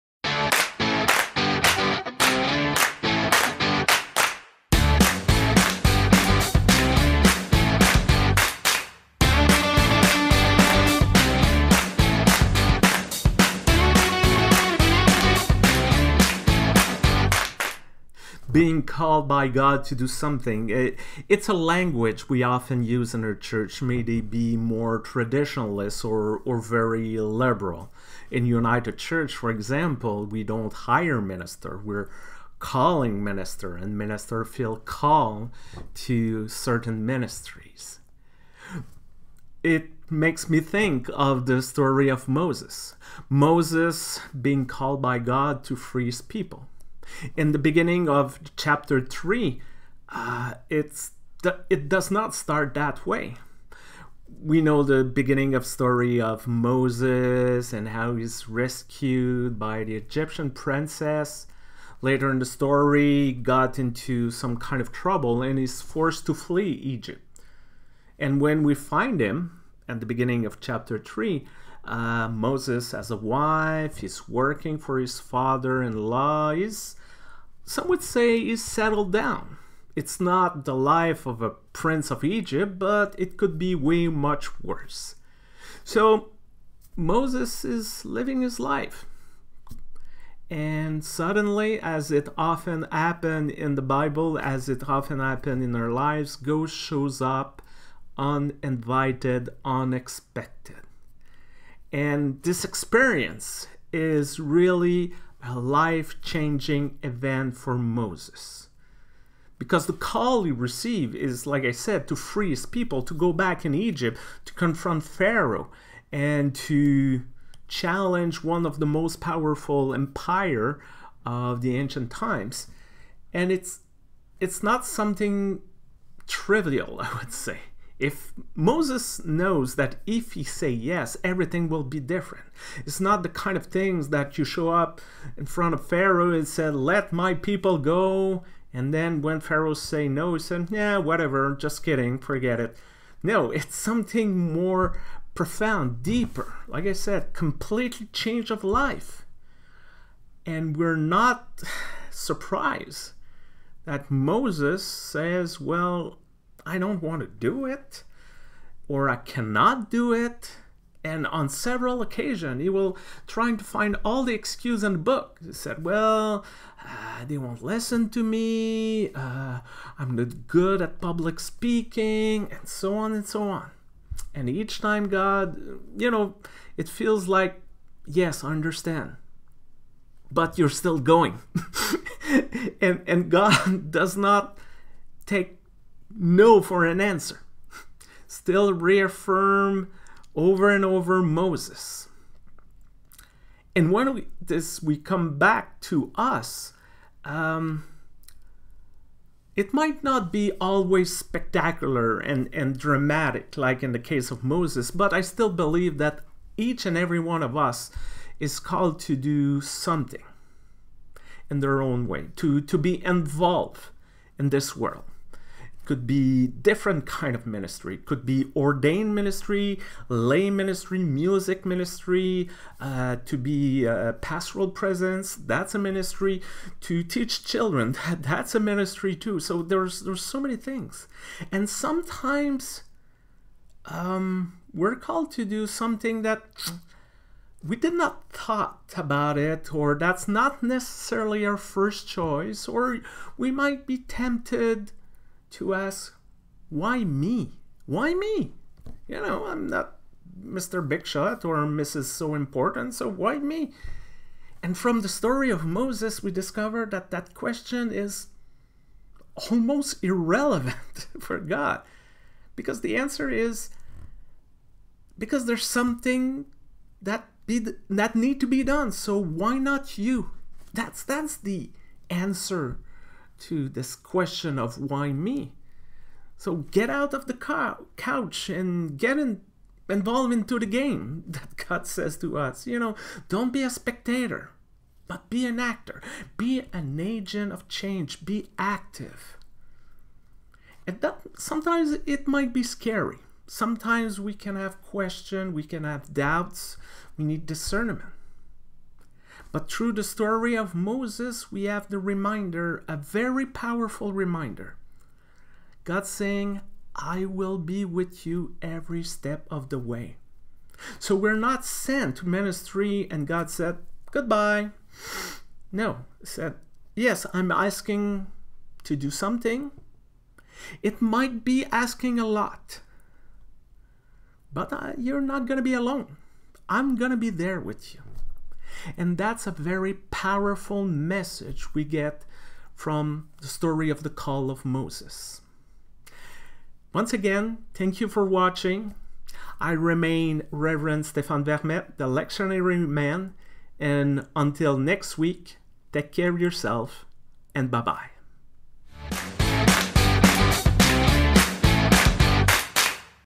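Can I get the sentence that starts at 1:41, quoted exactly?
And this experience is really a life changing event for Moses.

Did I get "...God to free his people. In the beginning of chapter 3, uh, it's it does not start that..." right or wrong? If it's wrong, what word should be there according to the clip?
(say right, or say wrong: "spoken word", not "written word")
right.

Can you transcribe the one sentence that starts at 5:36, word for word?
Once again, thank you for watching.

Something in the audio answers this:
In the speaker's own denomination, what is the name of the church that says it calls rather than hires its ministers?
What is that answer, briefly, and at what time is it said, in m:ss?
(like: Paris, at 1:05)
United Church, at 0:28.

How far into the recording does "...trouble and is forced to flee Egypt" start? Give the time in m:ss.
1:04.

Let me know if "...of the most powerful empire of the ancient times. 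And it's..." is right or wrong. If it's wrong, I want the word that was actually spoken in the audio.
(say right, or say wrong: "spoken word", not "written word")
right.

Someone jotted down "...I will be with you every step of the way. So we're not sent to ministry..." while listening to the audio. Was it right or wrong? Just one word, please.
right.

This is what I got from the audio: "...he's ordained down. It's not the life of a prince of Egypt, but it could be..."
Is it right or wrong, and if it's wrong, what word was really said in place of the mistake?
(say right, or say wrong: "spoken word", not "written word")
wrong: "settled", not "ordained".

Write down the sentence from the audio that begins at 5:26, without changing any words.
I'm going to be there with you.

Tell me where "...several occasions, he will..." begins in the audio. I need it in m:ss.
2:41.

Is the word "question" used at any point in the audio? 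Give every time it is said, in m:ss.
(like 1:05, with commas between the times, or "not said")
4:17, 4:33, 4:54.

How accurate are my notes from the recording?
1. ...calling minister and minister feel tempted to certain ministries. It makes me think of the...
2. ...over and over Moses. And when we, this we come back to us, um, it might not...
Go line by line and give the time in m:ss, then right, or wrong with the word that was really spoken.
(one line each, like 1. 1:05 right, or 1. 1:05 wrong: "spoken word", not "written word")
1. 0:32 wrong: "called", not "tempted"
2. 3:10 right.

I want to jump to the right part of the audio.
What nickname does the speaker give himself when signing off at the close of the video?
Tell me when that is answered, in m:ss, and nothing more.
5:41.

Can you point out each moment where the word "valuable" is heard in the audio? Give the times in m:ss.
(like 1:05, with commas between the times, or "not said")
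not said.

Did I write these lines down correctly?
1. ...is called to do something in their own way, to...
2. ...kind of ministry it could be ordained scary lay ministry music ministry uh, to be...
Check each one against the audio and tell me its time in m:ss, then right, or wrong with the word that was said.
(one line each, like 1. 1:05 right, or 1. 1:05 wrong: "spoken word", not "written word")
1. 3:28 right
2. 3:37 wrong: "ministry", not "scary".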